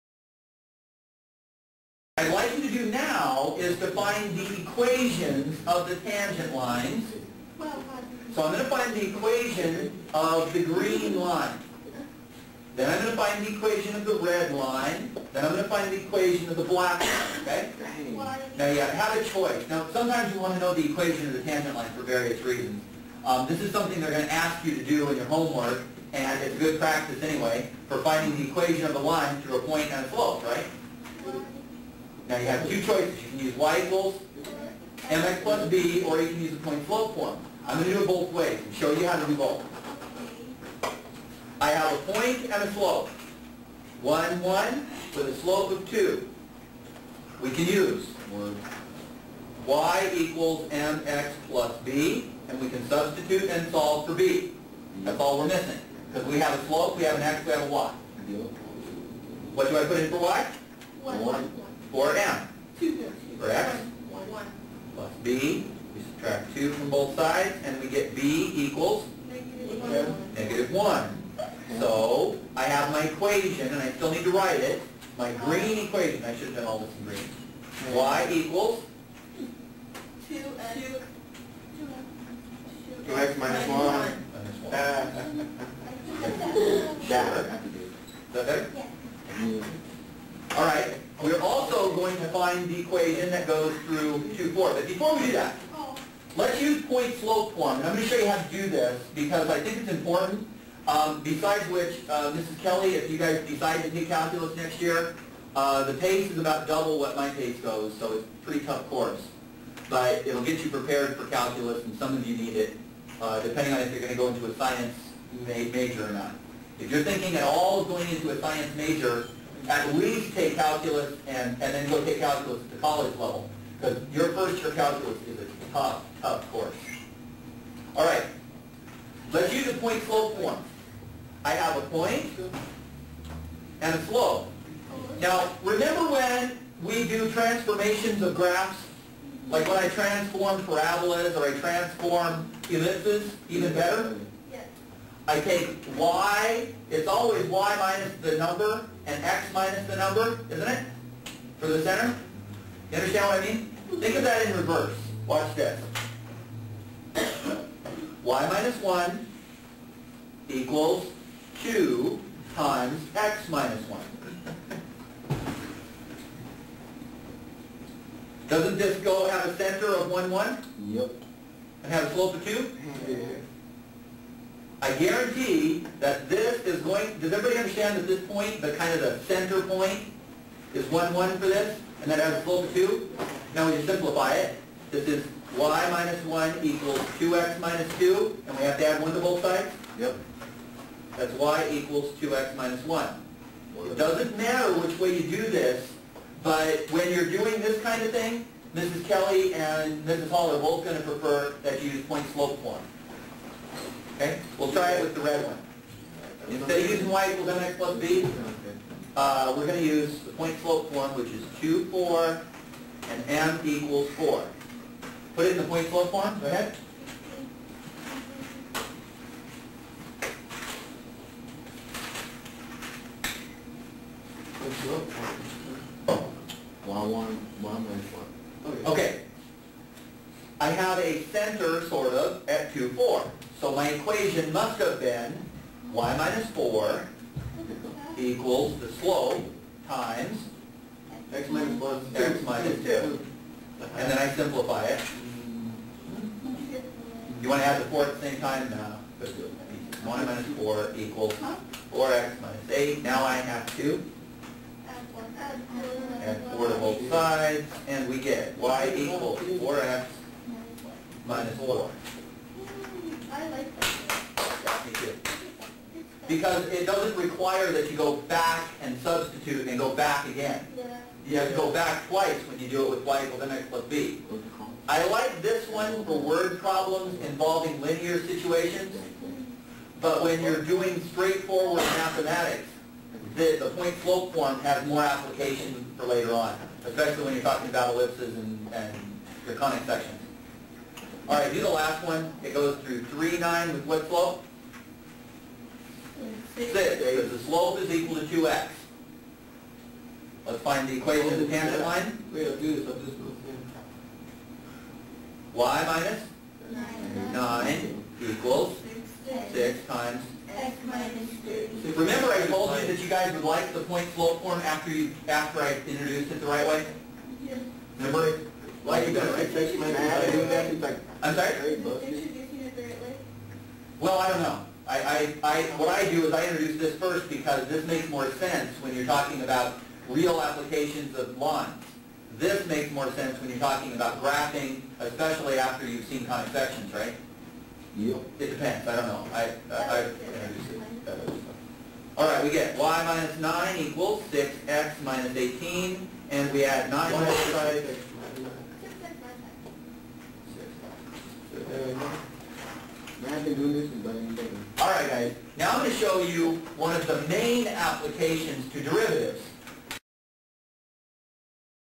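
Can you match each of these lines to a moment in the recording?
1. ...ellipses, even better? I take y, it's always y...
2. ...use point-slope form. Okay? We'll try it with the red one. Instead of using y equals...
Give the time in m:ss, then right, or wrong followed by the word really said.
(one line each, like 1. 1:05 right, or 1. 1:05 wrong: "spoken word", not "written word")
1. 2:22 right
2. 3:21 right.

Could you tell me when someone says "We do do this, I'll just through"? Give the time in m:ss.
5:02.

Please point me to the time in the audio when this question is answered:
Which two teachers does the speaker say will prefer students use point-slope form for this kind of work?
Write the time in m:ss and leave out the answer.
3:18.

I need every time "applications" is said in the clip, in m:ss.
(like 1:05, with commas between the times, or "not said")
4:45, 5:30, 5:57.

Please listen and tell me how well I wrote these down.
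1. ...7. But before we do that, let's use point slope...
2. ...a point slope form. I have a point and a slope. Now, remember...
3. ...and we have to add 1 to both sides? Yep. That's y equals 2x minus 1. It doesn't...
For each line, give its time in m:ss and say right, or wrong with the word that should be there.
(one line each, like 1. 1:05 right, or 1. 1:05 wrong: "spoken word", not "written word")
1. 1:34 wrong: "4", not "7"
2. 2:09 right
3. 3:08 right.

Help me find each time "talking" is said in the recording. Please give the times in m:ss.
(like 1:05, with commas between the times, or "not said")
4:47, 5:29, 5:33.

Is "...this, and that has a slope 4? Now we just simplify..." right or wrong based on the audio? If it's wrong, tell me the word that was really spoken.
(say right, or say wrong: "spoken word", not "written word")
wrong: "2", not "4".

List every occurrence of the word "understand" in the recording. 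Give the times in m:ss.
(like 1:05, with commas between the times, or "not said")
2:32, 2:57.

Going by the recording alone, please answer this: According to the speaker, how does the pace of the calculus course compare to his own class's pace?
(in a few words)
About double.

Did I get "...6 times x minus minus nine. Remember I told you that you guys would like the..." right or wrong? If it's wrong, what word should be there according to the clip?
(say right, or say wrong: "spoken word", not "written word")
wrong: "three", not "nine".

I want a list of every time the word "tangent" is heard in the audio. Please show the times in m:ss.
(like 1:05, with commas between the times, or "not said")
0:06, 0:21, 5:01.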